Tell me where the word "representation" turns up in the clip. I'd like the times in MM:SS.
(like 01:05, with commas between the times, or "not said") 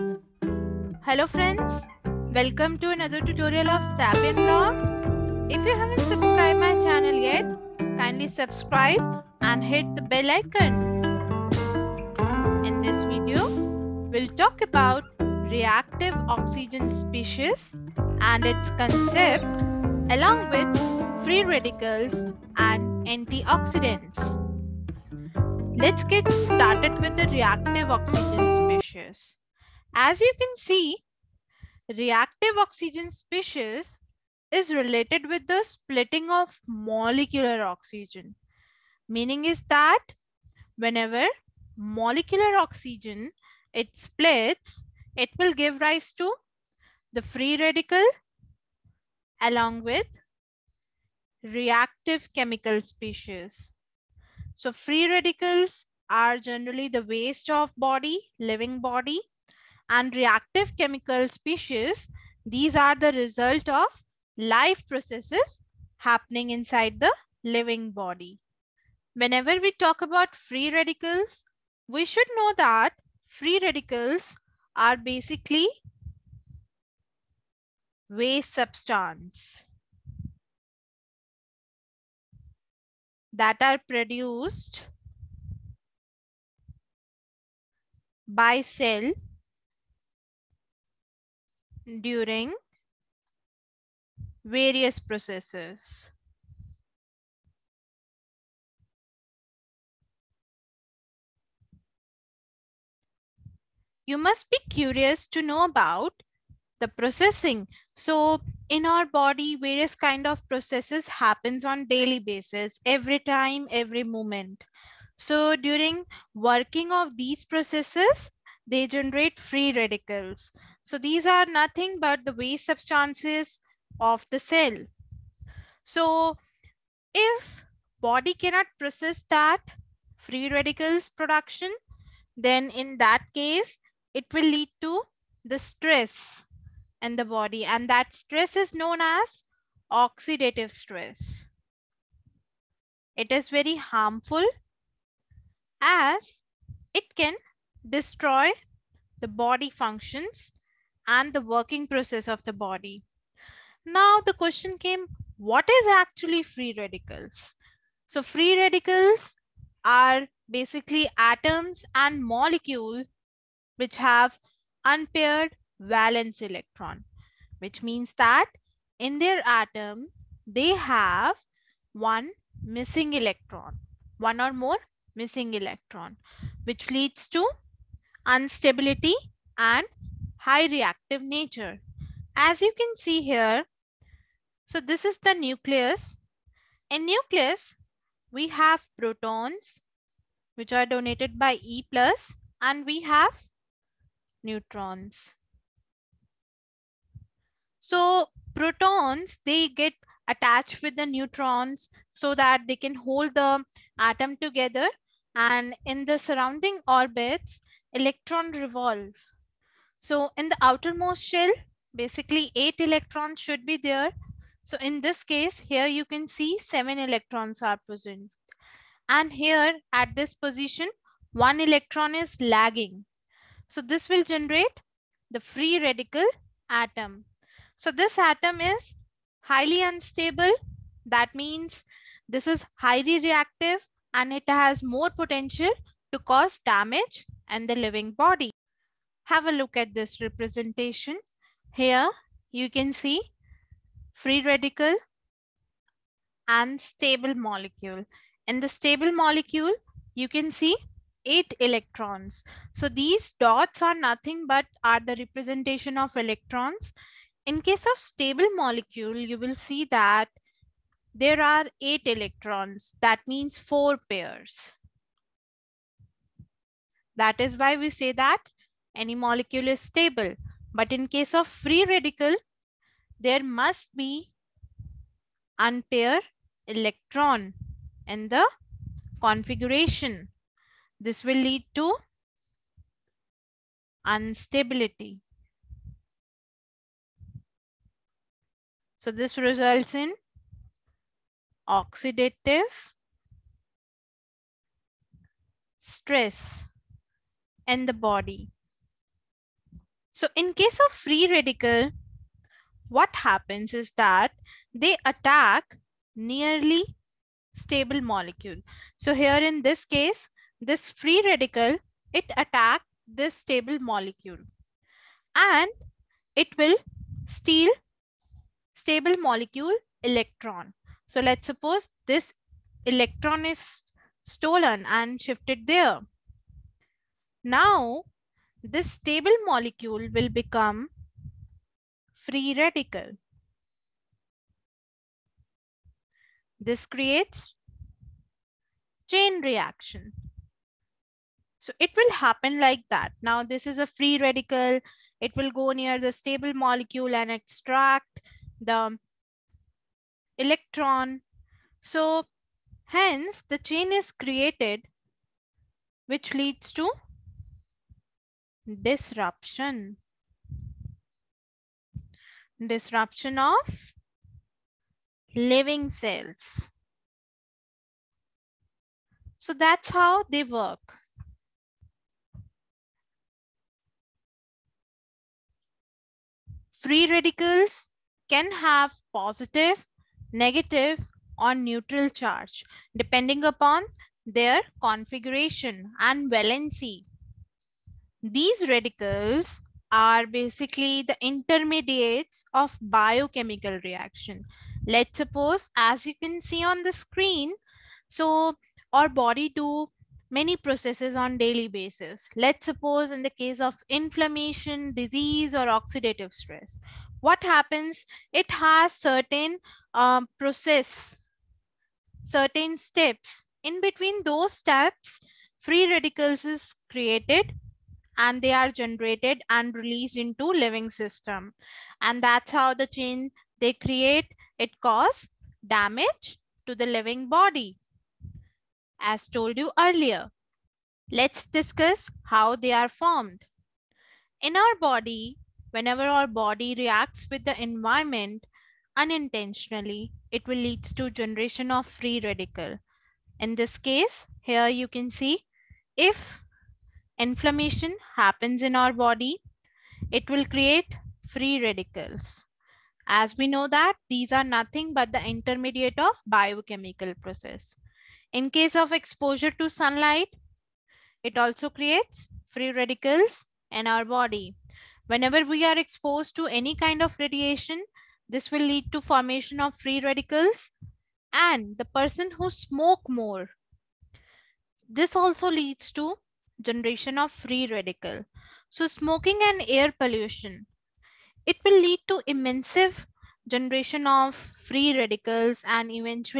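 04:00, 04:15.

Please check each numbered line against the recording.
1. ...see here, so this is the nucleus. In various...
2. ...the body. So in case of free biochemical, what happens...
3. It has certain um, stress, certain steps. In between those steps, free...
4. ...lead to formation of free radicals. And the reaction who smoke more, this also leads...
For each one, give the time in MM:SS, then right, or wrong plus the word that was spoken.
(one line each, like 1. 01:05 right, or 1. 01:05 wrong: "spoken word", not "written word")
1. 03:02 wrong: "nucleus", not "various"
2. 04:57 wrong: "radical", not "biochemical"
3. 06:48 wrong: "process", not "stress"
4. 07:48 wrong: "person", not "reaction".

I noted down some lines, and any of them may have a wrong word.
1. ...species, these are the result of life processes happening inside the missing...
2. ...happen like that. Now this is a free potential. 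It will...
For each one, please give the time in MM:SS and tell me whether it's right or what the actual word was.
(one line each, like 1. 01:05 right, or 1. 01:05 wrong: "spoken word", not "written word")
1. 01:01 wrong: "living", not "missing"
2. 05:42 wrong: "radical", not "potential".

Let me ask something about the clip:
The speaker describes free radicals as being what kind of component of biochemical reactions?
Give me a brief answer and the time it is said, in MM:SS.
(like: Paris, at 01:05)
intermediates, at 06:31.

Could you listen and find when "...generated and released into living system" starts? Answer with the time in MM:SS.
06:58.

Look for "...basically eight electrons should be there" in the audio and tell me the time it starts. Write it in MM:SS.
03:31.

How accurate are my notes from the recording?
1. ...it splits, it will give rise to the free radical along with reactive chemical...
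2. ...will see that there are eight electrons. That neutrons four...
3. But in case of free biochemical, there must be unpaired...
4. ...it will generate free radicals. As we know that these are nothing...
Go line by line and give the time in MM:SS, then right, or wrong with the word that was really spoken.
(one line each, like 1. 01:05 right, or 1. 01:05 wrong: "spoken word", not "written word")
1. 00:43 right
2. 04:19 wrong: "means", not "neutrons"
3. 04:30 wrong: "radical", not "biochemical"
4. 07:30 wrong: "create", not "generate".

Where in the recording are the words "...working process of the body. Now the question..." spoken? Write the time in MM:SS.
02:31.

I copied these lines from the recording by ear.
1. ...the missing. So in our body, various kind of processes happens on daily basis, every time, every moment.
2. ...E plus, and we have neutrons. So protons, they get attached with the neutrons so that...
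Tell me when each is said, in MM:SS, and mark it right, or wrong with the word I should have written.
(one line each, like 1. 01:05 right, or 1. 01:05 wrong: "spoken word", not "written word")
1. 01:46 wrong: "processing", not "missing"
2. 03:11 right.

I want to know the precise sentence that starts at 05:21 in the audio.
So let's suppose this electron is stolen and shifted there.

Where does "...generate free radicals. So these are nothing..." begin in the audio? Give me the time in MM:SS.
01:58.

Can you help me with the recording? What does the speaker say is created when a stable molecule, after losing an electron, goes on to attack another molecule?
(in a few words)
chain reaction.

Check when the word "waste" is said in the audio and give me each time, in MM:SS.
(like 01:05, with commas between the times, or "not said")
00:57, 01:18, 02:02.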